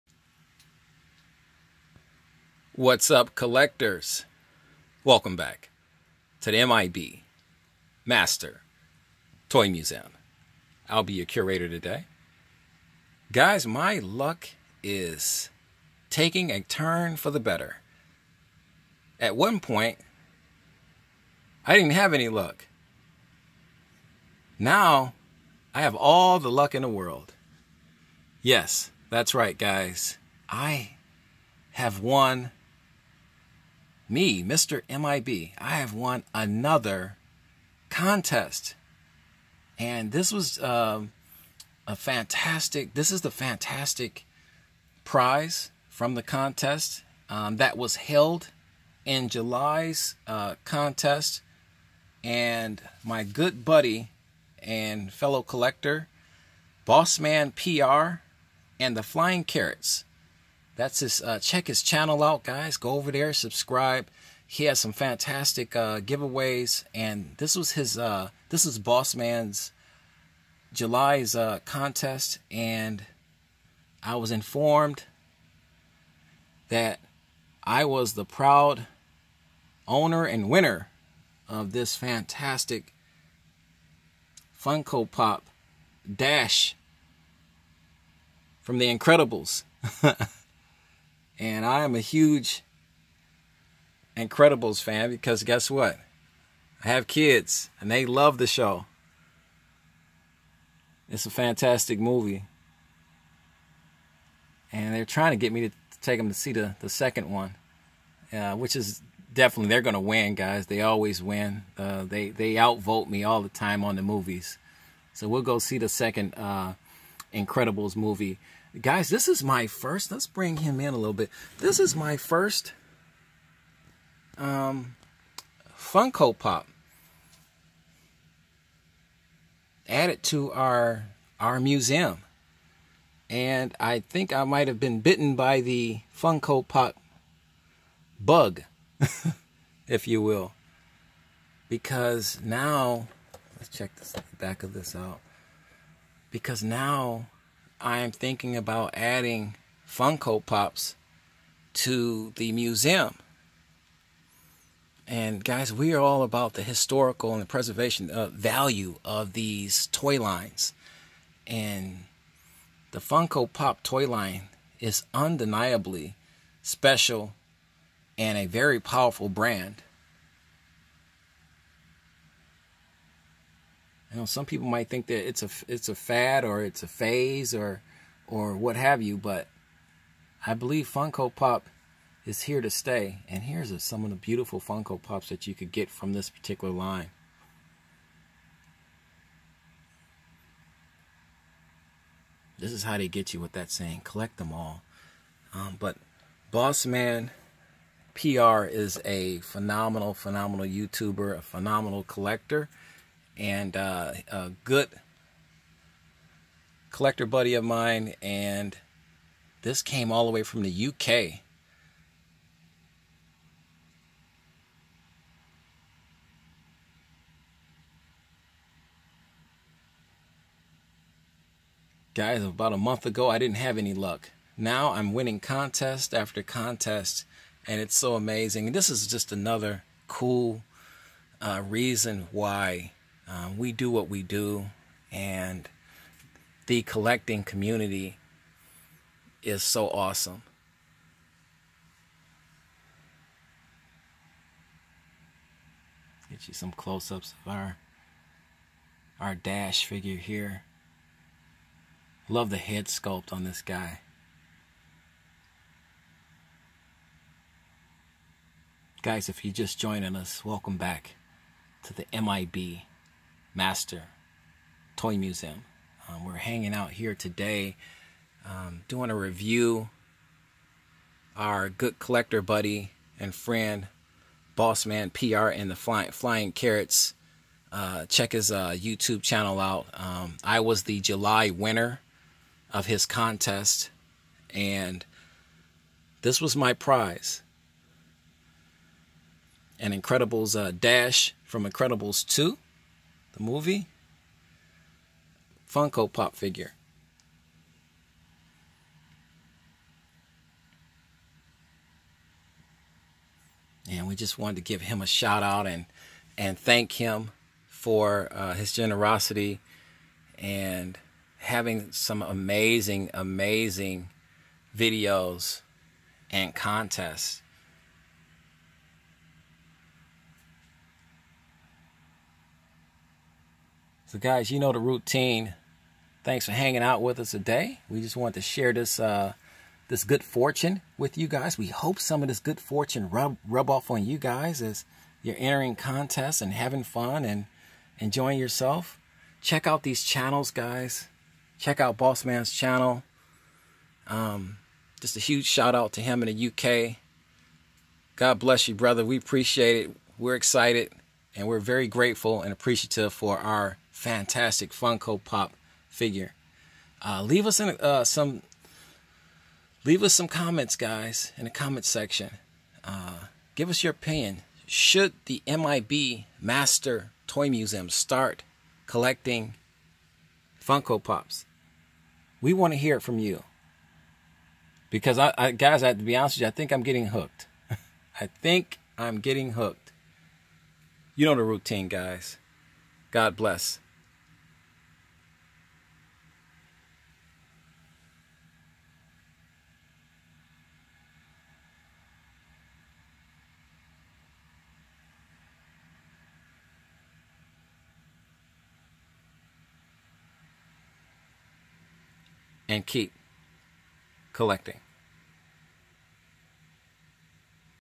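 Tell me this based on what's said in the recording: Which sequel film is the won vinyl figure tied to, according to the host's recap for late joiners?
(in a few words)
Incredibles 2.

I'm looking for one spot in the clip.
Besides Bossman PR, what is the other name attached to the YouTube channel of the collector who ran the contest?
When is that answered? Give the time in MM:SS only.
00:58.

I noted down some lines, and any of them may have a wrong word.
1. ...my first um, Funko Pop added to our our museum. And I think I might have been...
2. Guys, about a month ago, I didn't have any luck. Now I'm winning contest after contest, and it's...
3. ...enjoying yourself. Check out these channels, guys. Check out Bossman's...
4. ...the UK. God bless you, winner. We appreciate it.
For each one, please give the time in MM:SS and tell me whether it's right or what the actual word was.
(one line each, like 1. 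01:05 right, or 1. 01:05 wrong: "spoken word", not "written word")
1. 02:01 right
2. 03:42 right
3. 05:37 right
4. 05:46 wrong: "brother", not "winner".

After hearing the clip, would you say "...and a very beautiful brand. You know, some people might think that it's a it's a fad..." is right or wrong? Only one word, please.
wrong.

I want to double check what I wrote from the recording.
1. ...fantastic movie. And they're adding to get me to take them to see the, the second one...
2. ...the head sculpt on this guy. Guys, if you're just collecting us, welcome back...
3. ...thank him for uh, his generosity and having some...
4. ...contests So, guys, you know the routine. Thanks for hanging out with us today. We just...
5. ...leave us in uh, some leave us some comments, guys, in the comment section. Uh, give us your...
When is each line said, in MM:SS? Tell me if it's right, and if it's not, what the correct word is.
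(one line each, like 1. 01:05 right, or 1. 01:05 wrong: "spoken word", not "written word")
1. 01:41 wrong: "trying", not "adding"
2. 04:12 wrong: "joining", not "collecting"
3. 05:06 right
4. 05:16 right
5. 05:57 right.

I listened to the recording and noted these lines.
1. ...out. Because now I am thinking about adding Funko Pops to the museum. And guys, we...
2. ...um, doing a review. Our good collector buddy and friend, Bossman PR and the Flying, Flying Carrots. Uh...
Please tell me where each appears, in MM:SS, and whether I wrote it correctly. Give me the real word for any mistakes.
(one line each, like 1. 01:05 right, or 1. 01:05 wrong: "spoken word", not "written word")
1. 02:24 right
2. 04:28 right.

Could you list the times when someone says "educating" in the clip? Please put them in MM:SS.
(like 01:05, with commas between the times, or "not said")
not said.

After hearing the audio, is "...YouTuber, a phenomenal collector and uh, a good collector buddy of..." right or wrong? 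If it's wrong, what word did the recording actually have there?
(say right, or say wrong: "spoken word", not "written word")
right.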